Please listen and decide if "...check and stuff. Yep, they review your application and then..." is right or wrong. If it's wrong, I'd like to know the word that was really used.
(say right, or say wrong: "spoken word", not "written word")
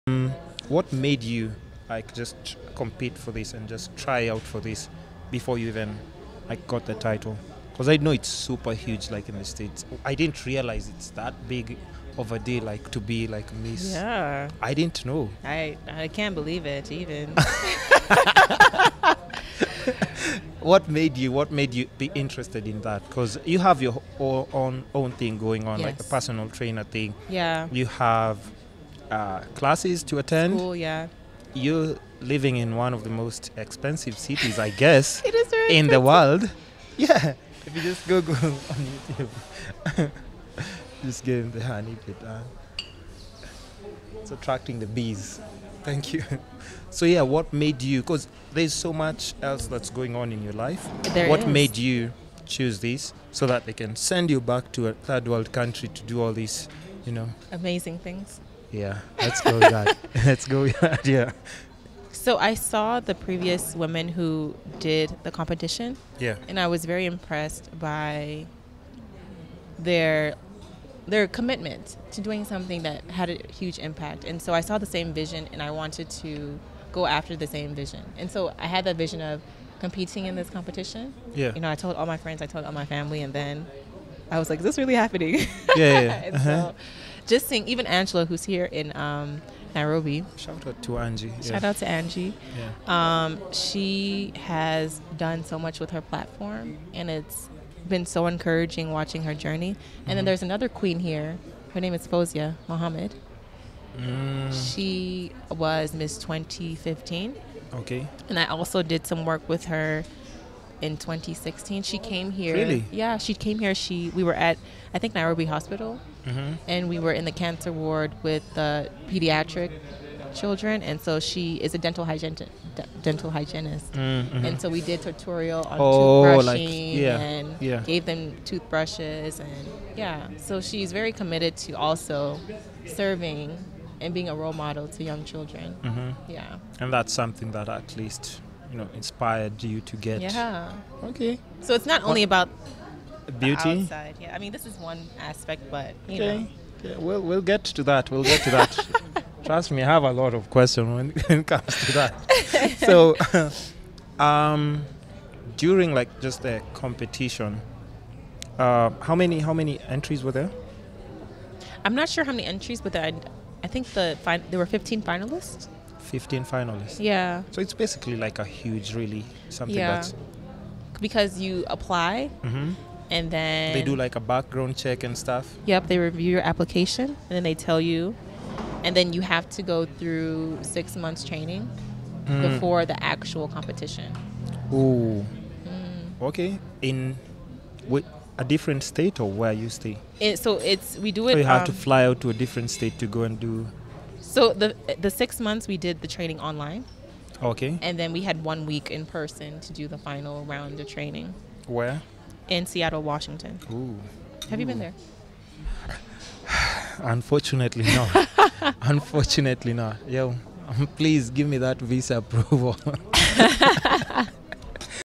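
right.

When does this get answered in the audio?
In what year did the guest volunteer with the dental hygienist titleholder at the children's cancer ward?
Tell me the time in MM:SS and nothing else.
01:50.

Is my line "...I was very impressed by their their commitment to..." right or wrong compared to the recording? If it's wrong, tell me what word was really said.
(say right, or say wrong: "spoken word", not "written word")
right.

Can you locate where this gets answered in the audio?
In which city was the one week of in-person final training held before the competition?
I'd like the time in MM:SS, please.
03:22.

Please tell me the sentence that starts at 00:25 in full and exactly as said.
like a personal trainer thing yeah you have uh, classes to attend.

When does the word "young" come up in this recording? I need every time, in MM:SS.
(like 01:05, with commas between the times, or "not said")
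02:15.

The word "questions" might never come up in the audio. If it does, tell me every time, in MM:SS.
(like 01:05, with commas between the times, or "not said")
02:30.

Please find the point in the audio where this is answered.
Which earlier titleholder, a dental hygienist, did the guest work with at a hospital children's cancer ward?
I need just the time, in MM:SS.
01:42.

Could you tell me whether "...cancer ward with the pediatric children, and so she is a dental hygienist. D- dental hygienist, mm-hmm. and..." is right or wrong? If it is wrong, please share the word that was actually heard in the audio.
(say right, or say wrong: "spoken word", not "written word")
right.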